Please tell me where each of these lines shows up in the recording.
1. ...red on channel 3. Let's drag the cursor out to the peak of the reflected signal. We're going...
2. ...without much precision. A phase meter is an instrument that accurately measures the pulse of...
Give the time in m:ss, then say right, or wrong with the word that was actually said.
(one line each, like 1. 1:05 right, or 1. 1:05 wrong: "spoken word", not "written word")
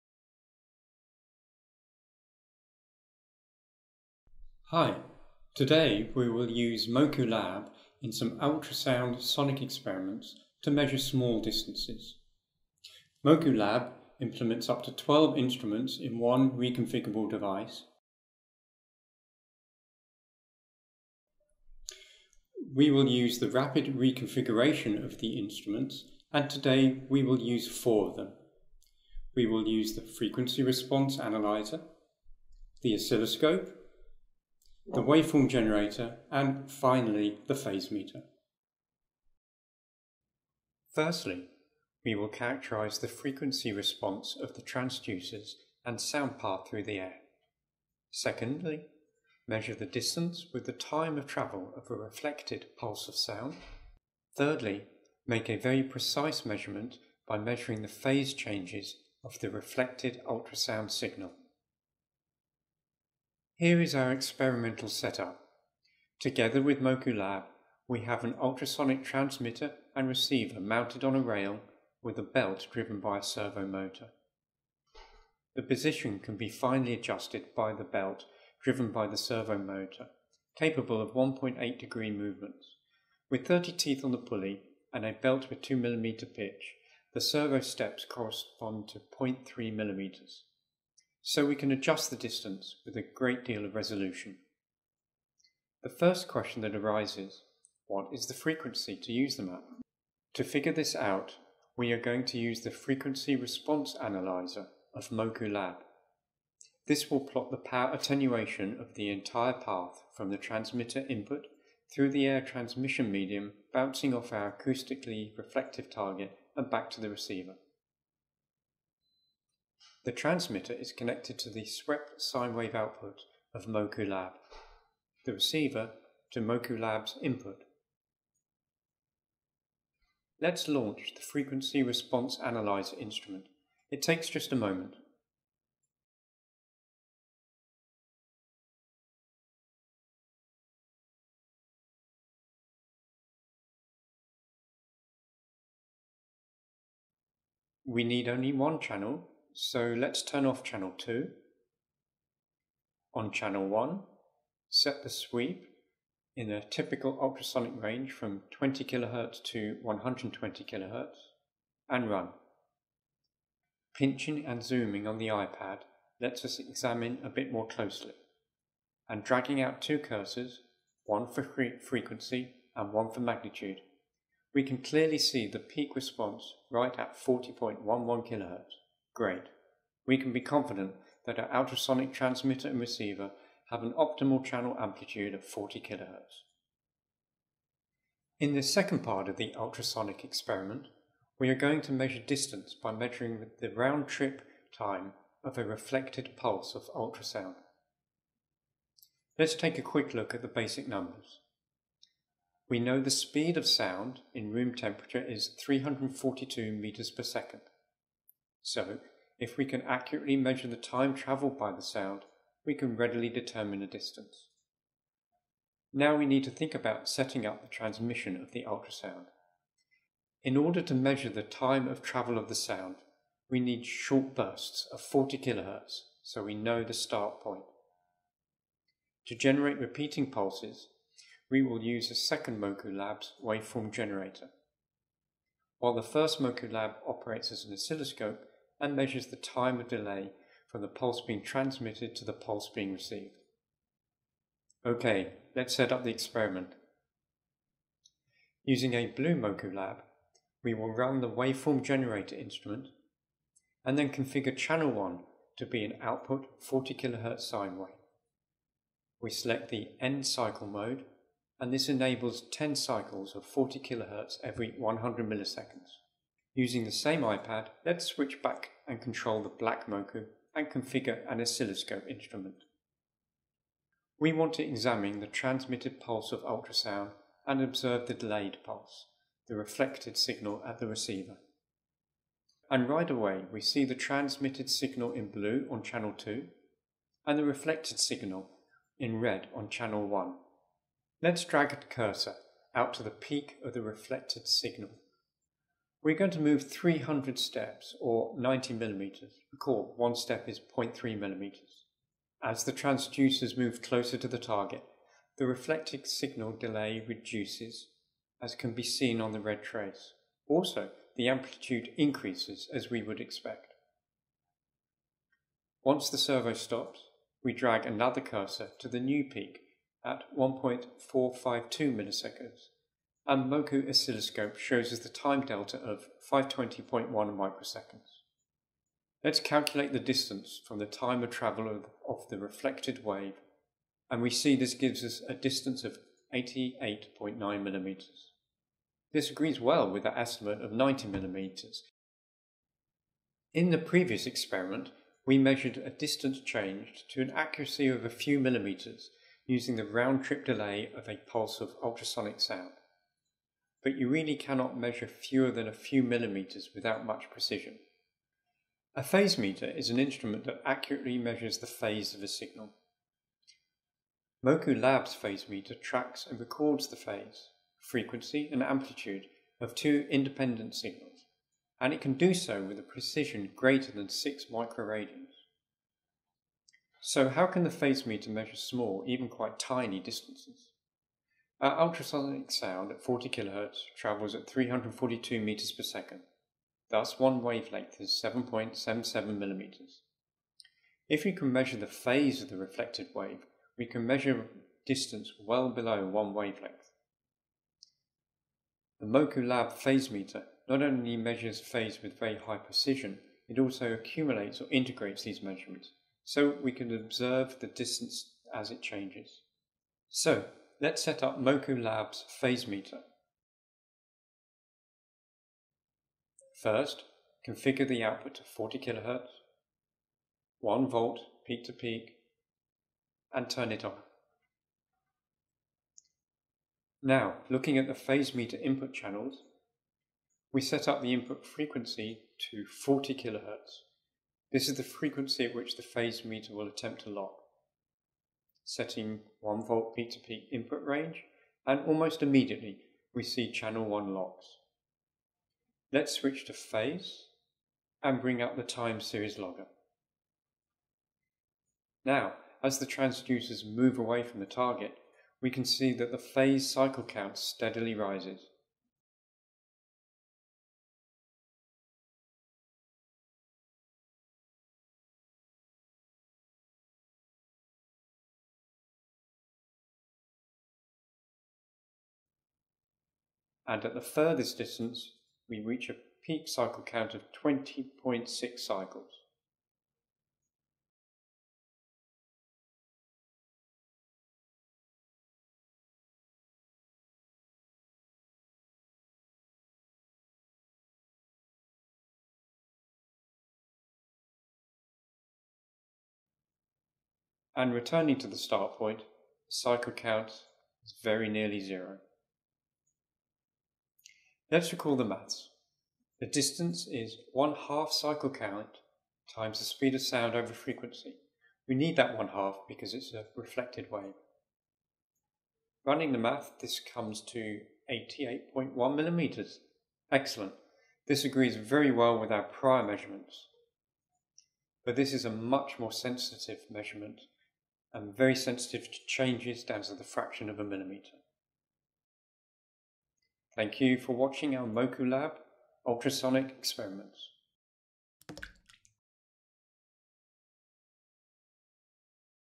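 1. 4:49 wrong: "1", not "3"
2. 5:56 wrong: "phase", not "pulse".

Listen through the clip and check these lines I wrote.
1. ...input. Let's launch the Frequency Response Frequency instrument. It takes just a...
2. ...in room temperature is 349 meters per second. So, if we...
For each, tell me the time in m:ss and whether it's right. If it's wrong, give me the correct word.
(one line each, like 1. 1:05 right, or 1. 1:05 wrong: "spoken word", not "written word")
1. 2:07 wrong: "Analyzer", not "Frequency"
2. 3:24 wrong: "342", not "349".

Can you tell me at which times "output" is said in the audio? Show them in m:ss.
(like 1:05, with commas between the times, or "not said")
2:02, 4:16, 6:58.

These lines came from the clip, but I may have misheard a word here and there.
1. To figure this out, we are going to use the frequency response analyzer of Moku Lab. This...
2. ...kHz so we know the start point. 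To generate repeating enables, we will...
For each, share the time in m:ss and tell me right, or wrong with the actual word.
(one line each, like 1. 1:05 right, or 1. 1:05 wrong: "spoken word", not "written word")
1. 1:40 right
2. 3:45 wrong: "pulses", not "enables".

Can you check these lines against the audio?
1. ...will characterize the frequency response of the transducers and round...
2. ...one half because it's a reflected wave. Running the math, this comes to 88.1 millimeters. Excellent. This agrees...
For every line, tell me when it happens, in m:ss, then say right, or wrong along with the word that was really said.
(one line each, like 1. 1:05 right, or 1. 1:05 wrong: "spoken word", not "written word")
1. 0:42 wrong: "sound", not "round"
2. 8:32 right.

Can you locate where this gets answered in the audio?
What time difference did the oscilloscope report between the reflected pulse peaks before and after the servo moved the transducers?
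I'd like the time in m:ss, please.
5:26.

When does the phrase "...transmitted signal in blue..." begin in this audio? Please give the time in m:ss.
4:43.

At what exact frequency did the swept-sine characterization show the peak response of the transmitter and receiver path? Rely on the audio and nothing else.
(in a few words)
40.11 kHz.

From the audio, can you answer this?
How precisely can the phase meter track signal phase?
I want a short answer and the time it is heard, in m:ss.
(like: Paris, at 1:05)
6 microradians, at 6:14.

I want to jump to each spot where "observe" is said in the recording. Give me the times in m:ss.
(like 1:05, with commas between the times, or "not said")
4:37, 6:46.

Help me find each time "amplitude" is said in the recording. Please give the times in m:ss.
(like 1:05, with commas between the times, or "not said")
3:04, 5:11, 6:08.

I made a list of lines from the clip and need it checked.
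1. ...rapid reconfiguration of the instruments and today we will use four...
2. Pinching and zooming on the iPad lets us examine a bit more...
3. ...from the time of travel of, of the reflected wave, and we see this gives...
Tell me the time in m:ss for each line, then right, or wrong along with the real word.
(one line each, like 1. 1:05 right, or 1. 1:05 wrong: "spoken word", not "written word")
1. 0:23 right
2. 2:43 right
3. 5:30 right.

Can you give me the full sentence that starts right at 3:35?
Now we need to think about setting up the transmission of the ultrasound.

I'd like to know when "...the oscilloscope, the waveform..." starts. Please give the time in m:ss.
0:32.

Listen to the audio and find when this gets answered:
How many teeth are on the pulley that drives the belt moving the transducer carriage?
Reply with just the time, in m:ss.
1:23.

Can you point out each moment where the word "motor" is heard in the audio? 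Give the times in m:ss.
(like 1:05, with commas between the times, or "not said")
1:13, 1:19.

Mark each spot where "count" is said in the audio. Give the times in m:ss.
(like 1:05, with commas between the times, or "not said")
7:37, 7:56, 8:19, 8:28.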